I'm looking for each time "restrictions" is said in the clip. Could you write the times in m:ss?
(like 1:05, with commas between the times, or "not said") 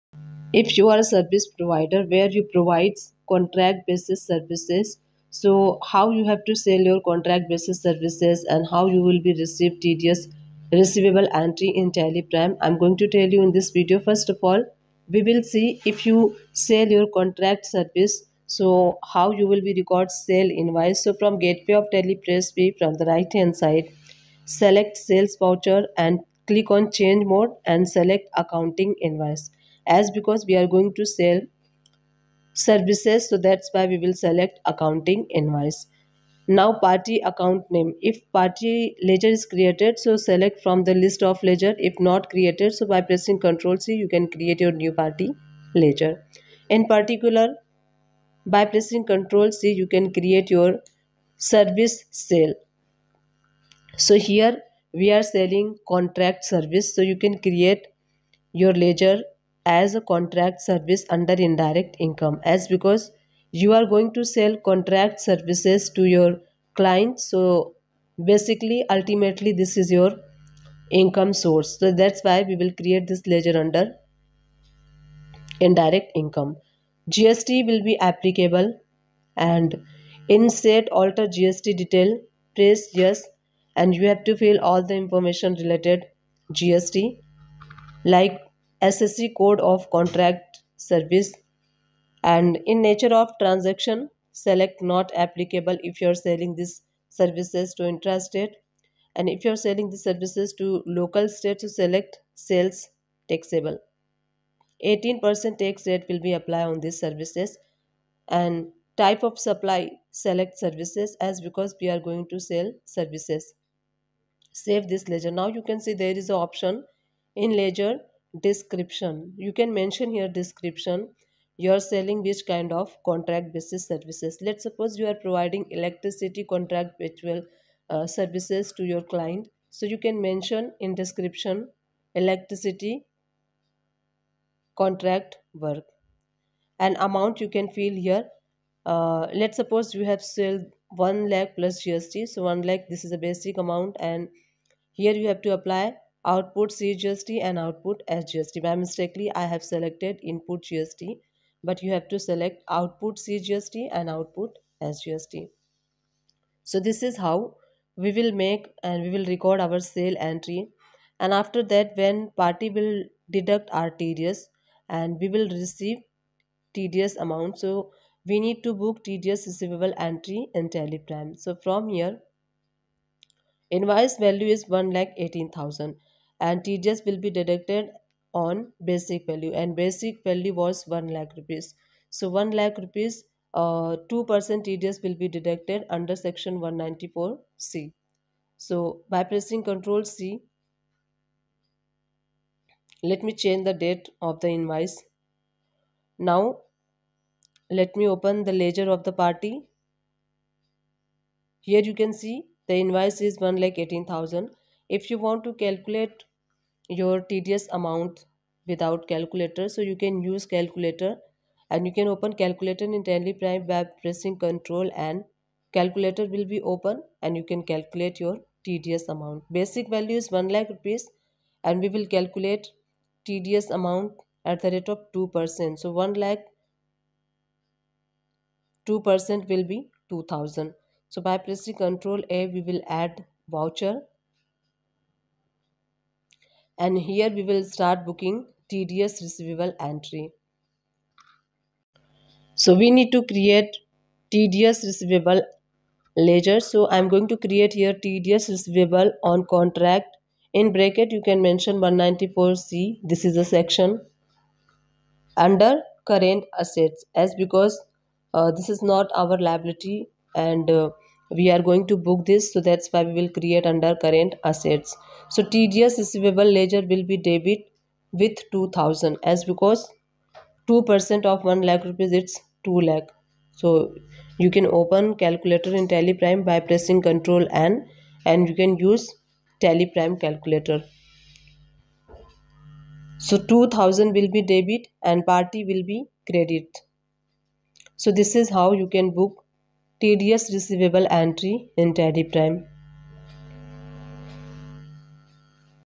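not said.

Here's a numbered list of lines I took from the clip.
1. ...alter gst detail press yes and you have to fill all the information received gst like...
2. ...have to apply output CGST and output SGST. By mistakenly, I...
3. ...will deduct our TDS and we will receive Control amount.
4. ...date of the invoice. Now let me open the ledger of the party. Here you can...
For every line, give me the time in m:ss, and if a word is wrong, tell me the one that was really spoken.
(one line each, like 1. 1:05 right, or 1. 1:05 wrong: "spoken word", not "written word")
1. 1:20 wrong: "related", not "received"
2. 2:25 right
3. 2:42 wrong: "TDS", not "Control"
4. 3:13 right.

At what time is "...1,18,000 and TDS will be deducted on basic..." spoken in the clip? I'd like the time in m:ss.
2:54.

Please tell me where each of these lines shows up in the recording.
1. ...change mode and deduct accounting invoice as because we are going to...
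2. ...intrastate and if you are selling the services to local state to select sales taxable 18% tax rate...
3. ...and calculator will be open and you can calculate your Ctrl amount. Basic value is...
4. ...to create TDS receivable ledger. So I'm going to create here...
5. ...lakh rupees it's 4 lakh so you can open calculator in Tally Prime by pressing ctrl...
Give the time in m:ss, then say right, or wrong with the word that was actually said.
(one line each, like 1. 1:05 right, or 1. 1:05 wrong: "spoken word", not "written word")
1. 0:26 wrong: "select", not "deduct"
2. 1:37 right
3. 3:35 wrong: "TDS", not "Ctrl"
4. 4:03 right
5. 4:31 wrong: "2", not "4".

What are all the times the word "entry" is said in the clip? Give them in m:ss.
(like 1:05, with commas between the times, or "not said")
0:11, 2:40, 2:49, 3:59, 4:51.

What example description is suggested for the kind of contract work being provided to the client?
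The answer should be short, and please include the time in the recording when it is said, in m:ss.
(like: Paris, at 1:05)
Electricity contract work, at 2:12.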